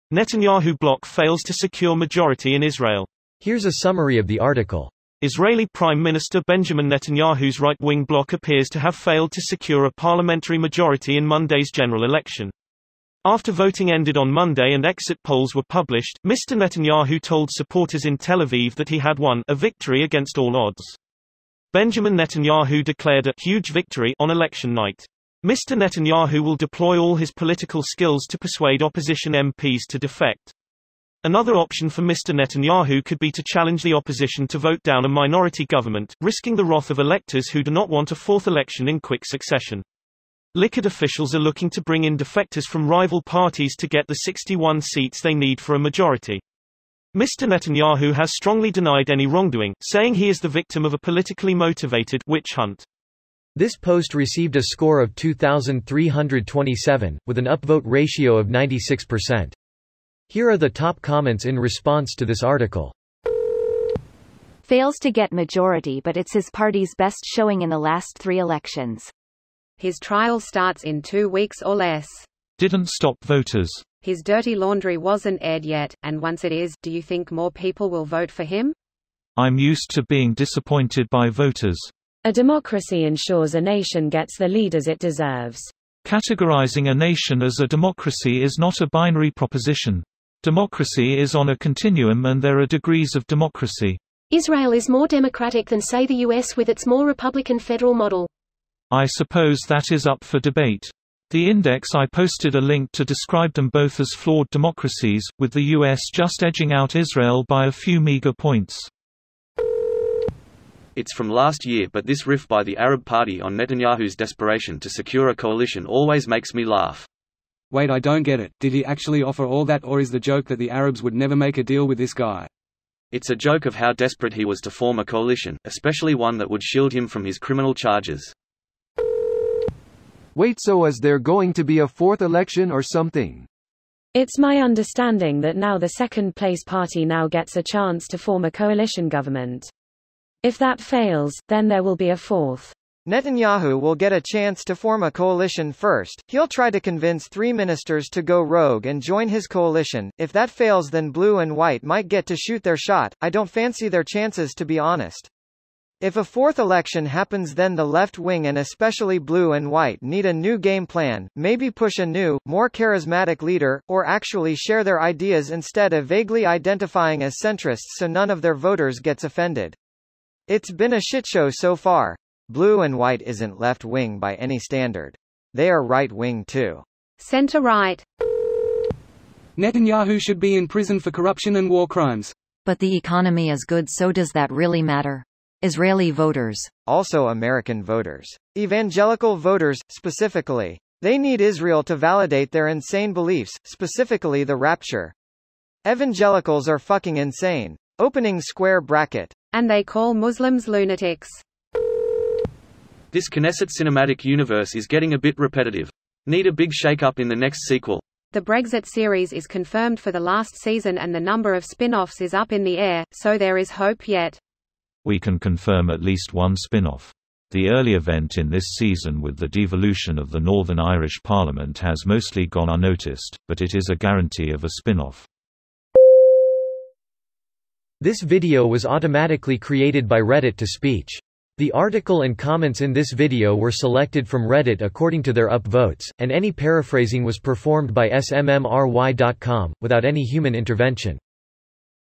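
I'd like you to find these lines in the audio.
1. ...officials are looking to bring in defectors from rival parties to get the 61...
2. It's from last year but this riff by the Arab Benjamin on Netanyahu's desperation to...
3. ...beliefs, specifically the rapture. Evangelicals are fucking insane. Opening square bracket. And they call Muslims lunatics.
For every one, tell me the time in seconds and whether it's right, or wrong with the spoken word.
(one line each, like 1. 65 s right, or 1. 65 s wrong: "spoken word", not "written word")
1. 40 s right
2. 110 s wrong: "Party", not "Benjamin"
3. 193 s right.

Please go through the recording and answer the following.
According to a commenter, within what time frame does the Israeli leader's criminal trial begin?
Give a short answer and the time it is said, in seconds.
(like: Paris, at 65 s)
Two weeks or less, at 71 s.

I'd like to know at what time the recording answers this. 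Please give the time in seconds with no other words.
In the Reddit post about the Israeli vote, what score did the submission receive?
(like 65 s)
55 s.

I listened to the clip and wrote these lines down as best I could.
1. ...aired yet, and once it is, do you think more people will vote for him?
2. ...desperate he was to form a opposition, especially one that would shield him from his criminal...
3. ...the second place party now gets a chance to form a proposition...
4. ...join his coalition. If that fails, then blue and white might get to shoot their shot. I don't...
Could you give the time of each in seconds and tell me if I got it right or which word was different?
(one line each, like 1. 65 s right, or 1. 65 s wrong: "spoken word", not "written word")
1. 75 s right
2. 123 s wrong: "coalition", not "opposition"
3. 135 s wrong: "coalition", not "proposition"
4. 149 s right.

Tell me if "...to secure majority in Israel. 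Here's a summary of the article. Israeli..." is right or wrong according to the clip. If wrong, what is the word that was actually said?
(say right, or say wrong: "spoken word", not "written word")
right.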